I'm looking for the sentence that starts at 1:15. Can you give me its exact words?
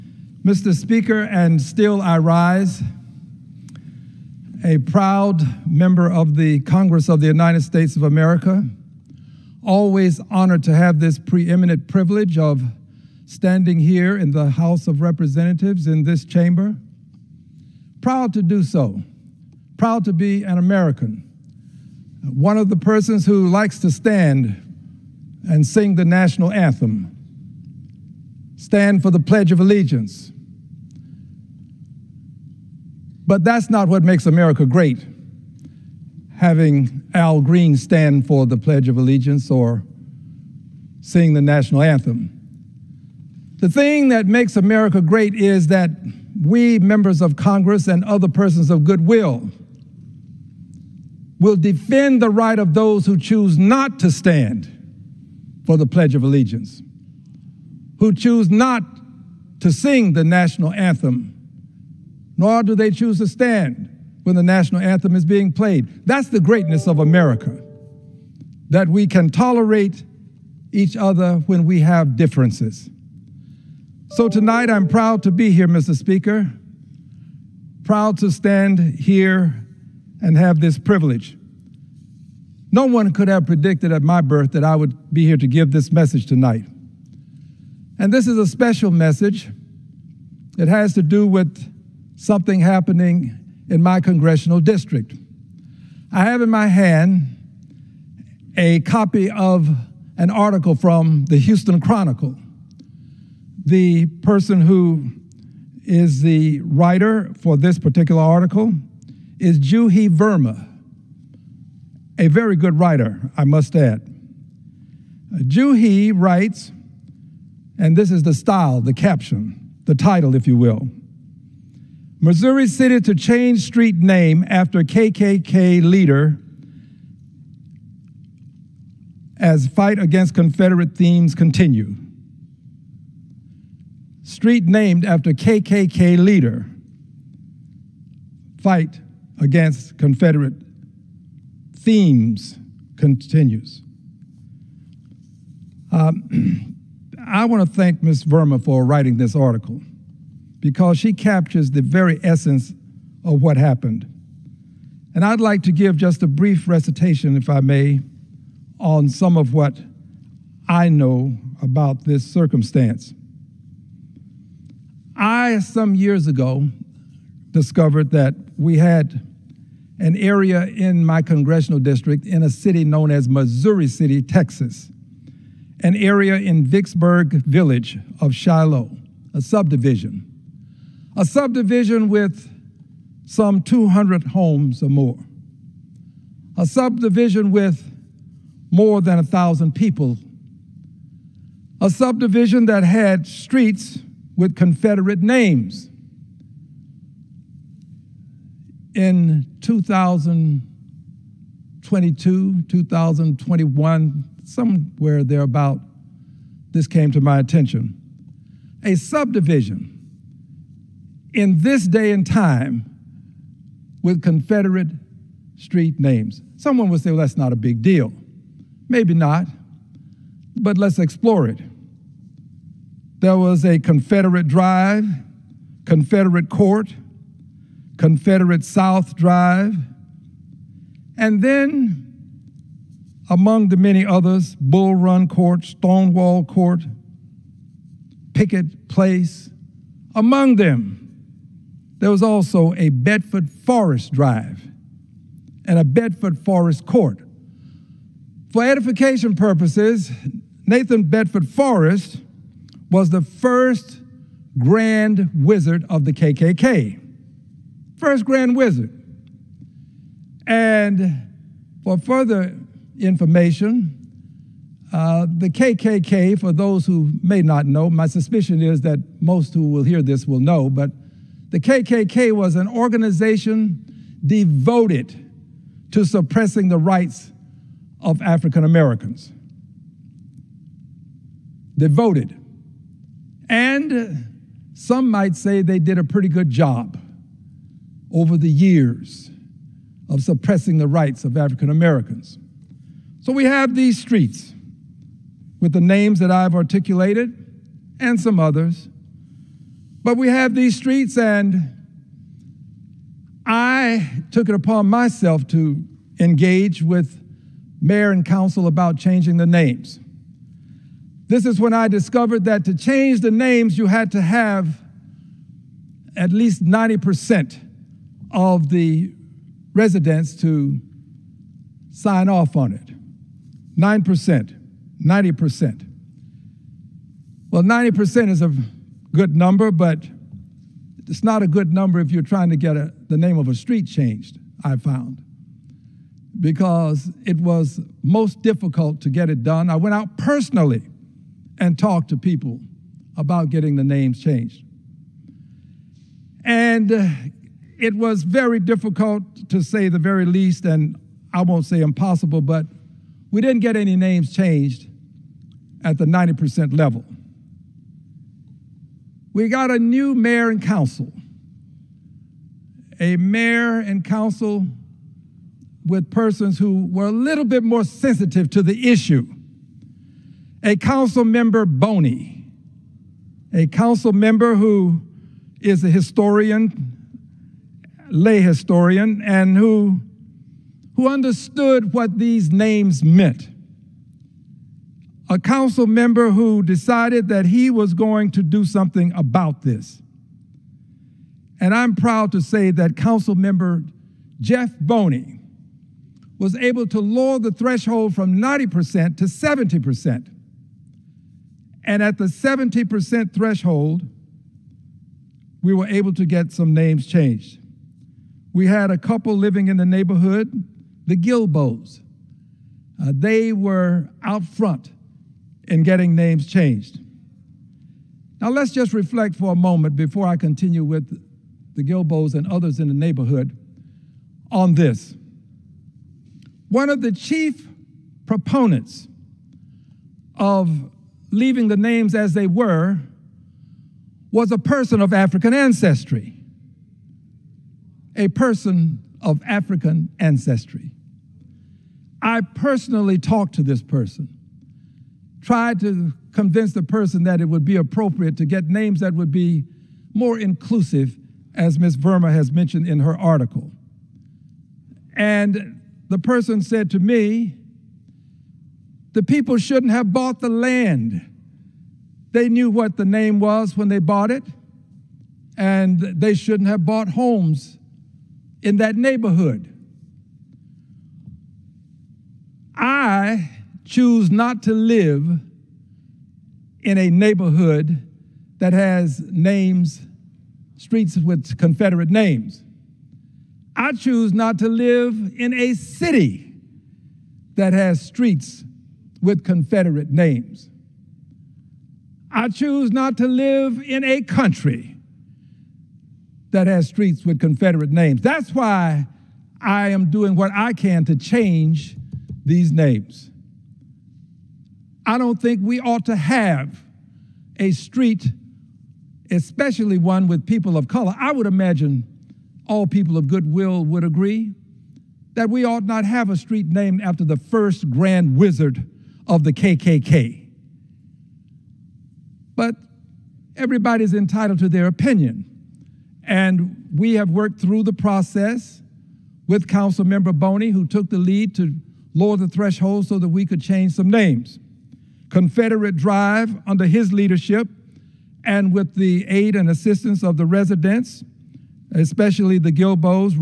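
Speaker, proud to stand here and have this privilege.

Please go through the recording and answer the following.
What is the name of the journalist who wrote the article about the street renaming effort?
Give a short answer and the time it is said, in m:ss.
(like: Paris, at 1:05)
Juhi Verma, at 1:49.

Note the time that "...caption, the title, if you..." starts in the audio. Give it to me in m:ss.
1:58.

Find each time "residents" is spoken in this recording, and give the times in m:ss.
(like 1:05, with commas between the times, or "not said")
5:19, 9:00.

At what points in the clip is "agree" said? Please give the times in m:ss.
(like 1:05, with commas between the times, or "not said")
8:34.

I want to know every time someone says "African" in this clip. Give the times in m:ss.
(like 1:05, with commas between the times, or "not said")
4:38, 4:51, 7:15, 7:19.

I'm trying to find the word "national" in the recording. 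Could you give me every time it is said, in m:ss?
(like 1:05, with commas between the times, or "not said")
0:26, 0:41, 1:00, 1:04.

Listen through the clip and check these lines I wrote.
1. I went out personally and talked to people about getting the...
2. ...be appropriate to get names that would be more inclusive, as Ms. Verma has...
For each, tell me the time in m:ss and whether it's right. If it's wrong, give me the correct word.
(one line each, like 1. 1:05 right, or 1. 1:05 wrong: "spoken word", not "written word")
1. 5:39 right
2. 7:27 right.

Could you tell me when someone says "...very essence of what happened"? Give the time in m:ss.
2:31.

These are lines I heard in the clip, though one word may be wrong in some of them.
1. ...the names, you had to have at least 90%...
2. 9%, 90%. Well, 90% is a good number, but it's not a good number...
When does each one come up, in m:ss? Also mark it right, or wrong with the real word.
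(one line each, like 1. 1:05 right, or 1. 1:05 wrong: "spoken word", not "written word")
1. 5:13 right
2. 5:23 right.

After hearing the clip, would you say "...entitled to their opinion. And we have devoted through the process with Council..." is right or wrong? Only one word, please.
wrong.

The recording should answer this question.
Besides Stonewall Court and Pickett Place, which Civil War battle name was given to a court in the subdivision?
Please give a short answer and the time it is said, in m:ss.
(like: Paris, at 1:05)
Bull Run Court, at 3:54.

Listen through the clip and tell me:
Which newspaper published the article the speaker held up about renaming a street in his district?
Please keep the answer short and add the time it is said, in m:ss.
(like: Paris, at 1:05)
Houston Chronicle, at 1:41.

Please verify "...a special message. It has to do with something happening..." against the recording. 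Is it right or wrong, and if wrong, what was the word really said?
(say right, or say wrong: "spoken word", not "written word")
right.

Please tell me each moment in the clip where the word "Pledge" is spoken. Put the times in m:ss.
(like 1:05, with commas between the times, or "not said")
0:29, 0:38, 0:55.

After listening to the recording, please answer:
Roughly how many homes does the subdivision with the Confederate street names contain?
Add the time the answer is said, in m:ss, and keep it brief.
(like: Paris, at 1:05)
200, at 3:03.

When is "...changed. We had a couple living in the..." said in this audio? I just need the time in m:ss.
6:47.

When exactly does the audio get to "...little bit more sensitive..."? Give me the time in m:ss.
6:07.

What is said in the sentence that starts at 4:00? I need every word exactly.
Among them, there was also a Bedford Forest Drive and a Bedford Forest Court.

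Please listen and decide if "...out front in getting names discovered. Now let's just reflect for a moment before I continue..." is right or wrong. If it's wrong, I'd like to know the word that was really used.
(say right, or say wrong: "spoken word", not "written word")
wrong: "changed", not "discovered".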